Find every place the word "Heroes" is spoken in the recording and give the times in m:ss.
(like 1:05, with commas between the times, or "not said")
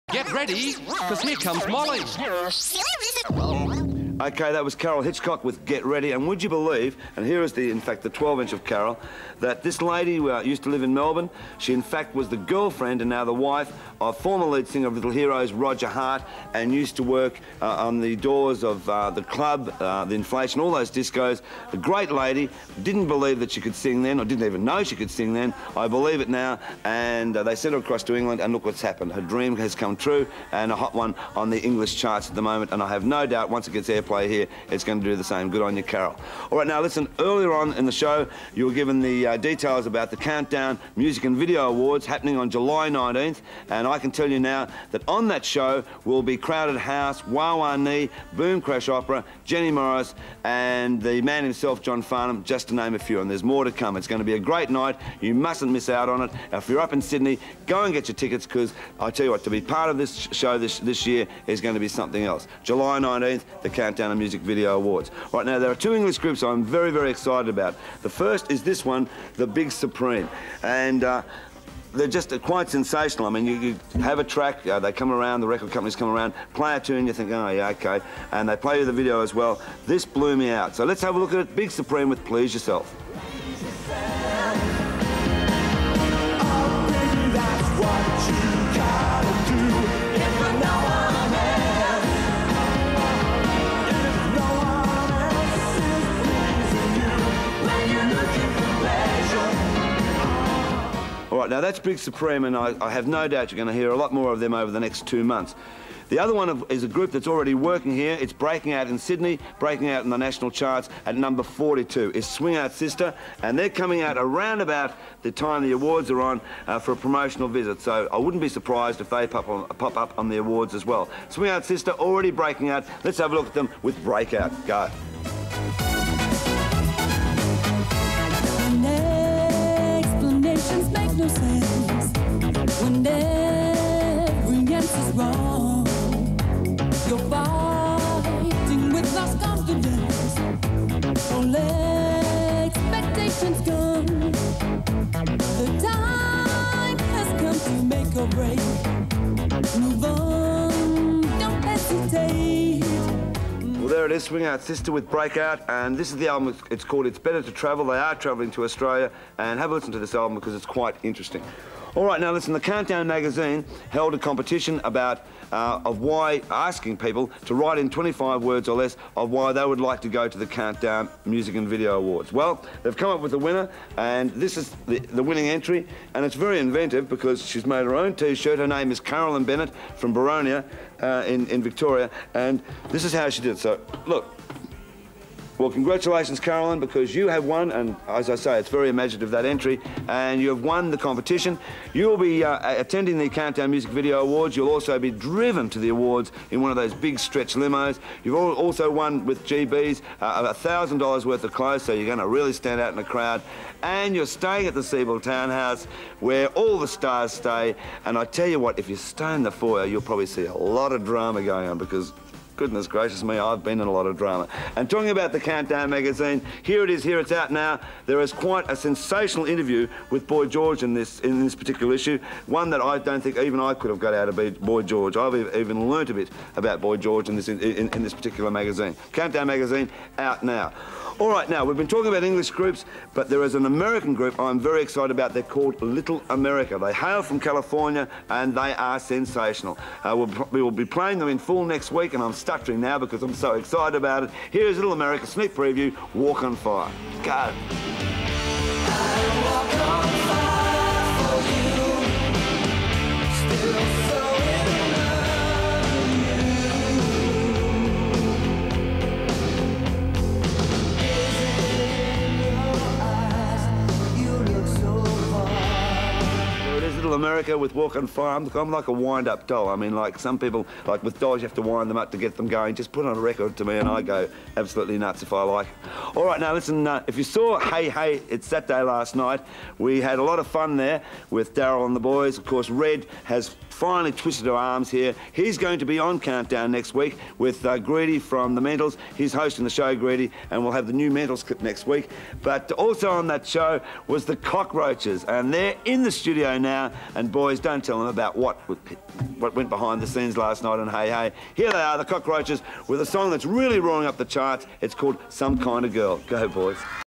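0:15.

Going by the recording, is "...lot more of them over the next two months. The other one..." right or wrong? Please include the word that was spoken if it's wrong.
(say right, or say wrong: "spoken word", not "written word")
right.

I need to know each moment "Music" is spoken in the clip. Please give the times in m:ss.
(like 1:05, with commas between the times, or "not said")
0:40, 1:04, 2:51, 3:13.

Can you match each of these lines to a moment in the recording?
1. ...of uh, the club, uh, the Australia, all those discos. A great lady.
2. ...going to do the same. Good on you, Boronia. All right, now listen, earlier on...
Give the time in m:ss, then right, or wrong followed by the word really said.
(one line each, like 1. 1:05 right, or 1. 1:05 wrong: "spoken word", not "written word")
1. 0:18 wrong: "Inflation", not "Australia"
2. 0:34 wrong: "Carol", not "Boronia".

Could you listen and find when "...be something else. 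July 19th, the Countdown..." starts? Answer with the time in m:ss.
1:01.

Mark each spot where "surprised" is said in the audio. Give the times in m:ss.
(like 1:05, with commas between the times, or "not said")
1:58.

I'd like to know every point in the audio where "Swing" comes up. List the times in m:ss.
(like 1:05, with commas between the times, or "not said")
1:52, 2:01, 2:34.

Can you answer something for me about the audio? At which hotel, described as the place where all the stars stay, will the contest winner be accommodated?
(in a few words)
Sebel Townhouse.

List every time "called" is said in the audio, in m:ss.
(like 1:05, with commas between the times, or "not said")
2:36, 3:55, 5:04.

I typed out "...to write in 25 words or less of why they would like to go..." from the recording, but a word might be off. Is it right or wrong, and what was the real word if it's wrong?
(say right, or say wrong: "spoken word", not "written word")
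right.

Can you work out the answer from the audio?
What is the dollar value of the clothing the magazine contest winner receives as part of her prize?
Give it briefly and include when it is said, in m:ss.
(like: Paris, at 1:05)
$1,000, at 3:20.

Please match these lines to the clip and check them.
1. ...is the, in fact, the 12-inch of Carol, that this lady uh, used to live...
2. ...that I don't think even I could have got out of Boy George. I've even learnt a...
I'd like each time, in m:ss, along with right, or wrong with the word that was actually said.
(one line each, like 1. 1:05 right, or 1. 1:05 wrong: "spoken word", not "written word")
1. 0:07 right
2. 3:42 right.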